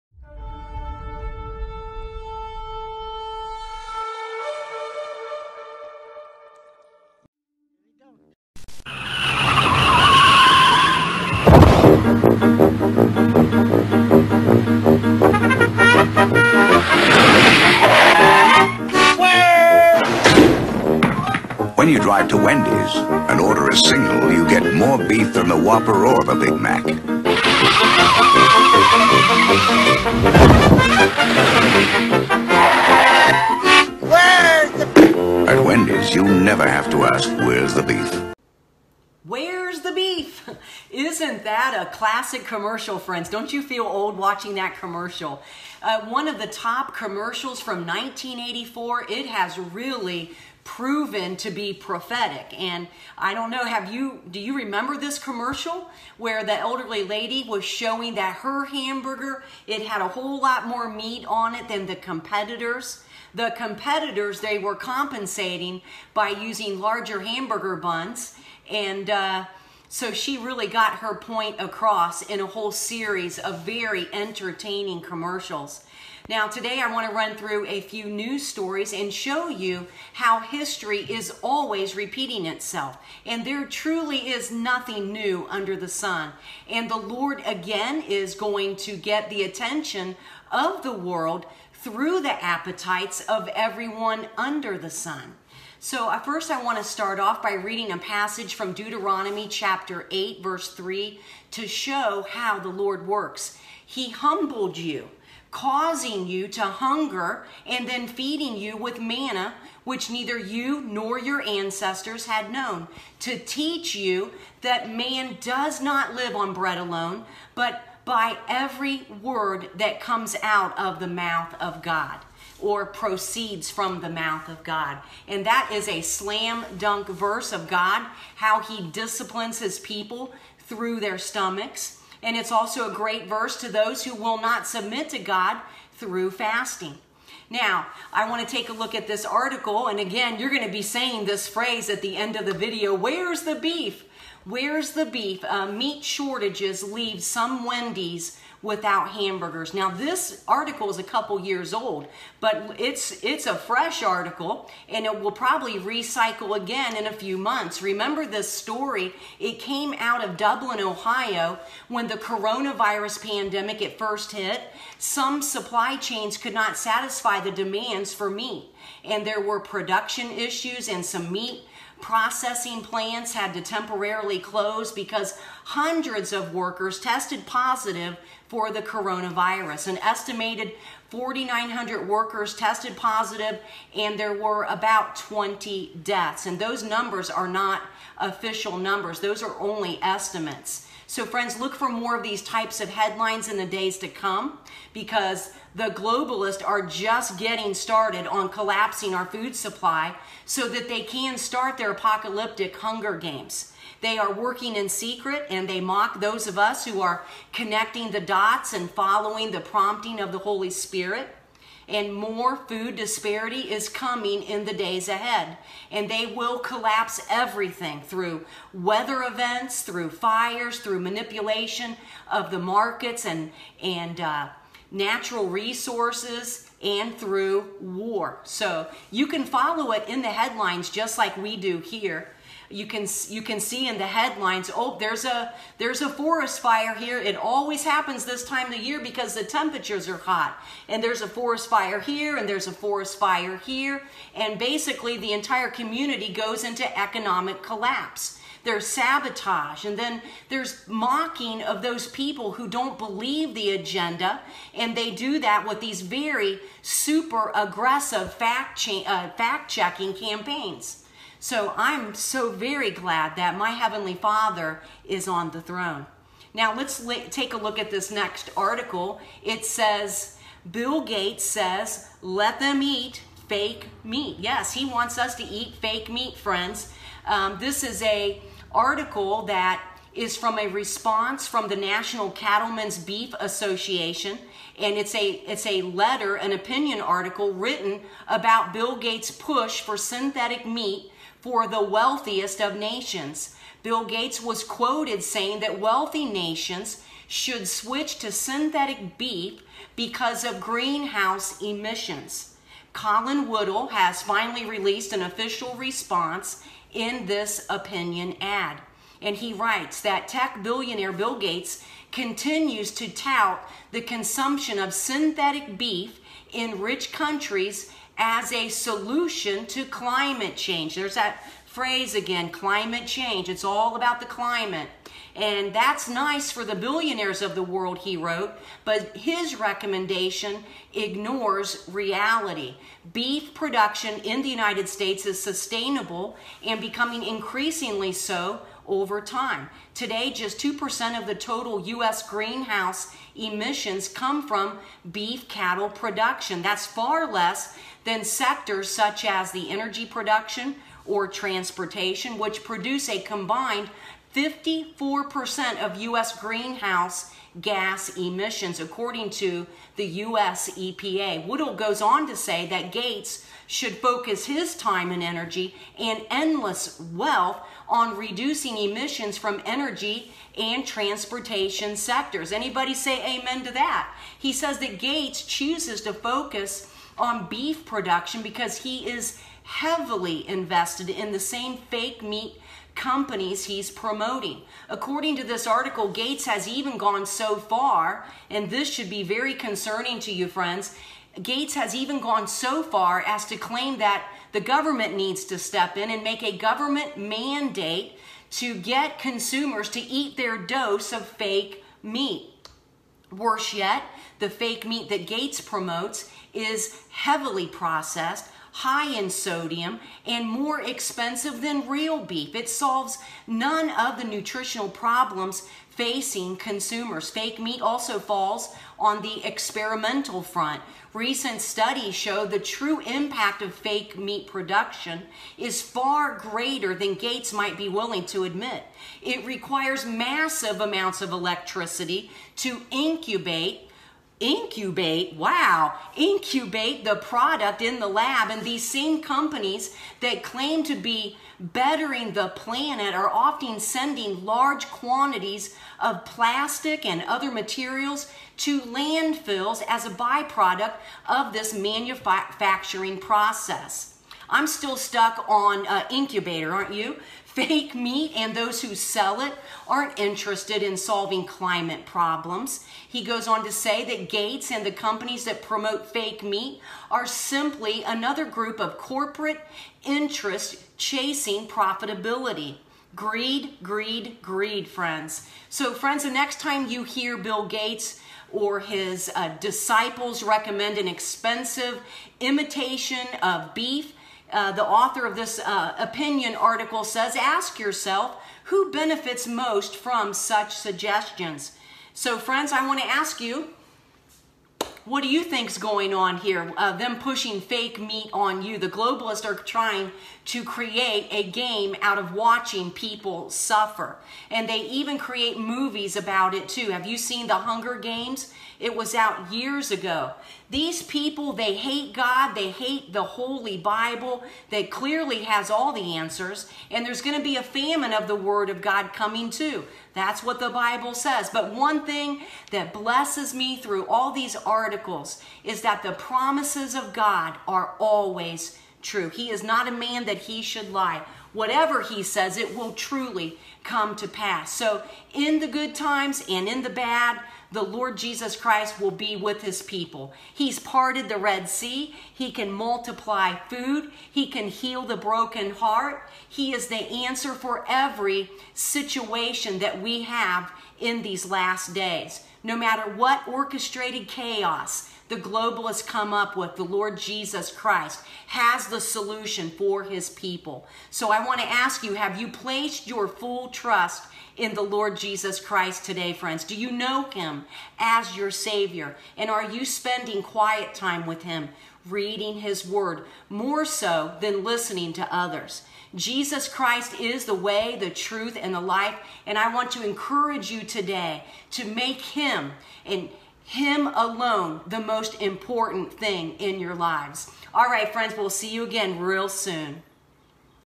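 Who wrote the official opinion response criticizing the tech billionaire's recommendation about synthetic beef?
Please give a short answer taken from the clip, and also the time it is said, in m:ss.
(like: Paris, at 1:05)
Colin Woodall, at 5:02.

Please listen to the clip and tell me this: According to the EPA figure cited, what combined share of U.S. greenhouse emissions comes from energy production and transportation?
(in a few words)
54%.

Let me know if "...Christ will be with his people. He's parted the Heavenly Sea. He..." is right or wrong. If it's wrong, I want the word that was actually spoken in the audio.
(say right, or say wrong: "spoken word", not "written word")
wrong: "Red", not "Heavenly".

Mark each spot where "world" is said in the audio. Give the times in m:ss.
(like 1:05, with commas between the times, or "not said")
1:30, 5:27.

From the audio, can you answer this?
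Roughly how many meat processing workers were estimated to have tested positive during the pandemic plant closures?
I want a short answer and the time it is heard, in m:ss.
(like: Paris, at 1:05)
4,900, at 3:01.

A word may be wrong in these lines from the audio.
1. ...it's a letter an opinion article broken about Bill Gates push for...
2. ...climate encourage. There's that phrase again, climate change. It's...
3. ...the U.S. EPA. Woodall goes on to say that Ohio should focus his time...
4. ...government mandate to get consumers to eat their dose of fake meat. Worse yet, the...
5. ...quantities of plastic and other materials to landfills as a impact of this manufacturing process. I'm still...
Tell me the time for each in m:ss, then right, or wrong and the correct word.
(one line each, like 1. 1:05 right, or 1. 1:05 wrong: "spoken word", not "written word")
1. 4:45 wrong: "written", not "broken"
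2. 5:19 wrong: "change", not "encourage"
3. 5:59 wrong: "Gates", not "Ohio"
4. 6:36 right
5. 7:24 wrong: "byproduct", not "impact".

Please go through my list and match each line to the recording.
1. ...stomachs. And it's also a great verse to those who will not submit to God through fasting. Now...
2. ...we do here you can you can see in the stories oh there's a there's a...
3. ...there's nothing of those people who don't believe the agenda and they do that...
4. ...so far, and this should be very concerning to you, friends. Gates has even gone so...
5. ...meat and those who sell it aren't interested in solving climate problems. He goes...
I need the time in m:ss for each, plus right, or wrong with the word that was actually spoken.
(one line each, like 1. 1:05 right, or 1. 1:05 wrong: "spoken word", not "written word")
1. 2:11 right
2. 3:51 wrong: "headlines", not "stories"
3. 4:10 wrong: "mocking", not "nothing"
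4. 6:27 right
5. 7:37 right.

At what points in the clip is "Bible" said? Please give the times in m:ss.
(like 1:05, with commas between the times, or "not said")
8:33, 8:40.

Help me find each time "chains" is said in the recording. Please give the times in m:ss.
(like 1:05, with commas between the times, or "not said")
2:45.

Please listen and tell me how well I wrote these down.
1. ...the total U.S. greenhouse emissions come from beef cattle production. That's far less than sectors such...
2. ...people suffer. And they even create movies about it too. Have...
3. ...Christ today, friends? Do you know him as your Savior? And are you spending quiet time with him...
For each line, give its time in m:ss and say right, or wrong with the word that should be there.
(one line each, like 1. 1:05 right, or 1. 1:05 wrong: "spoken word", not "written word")
1. 5:41 right
2. 8:22 right
3. 9:25 right.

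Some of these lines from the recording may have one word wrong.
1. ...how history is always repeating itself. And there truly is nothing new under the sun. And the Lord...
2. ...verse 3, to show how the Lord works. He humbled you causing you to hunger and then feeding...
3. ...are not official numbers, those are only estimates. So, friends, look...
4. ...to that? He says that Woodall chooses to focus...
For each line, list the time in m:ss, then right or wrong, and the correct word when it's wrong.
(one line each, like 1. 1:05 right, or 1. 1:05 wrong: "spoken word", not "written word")
1. 1:20 right
2. 1:40 right
3. 3:07 right
4. 6:13 wrong: "Gates", not "Woodall".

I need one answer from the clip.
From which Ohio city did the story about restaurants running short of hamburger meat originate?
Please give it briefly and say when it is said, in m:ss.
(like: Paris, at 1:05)
Dublin, at 2:40.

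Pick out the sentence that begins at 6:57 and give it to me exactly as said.
Fake meat also falls on the experimental front.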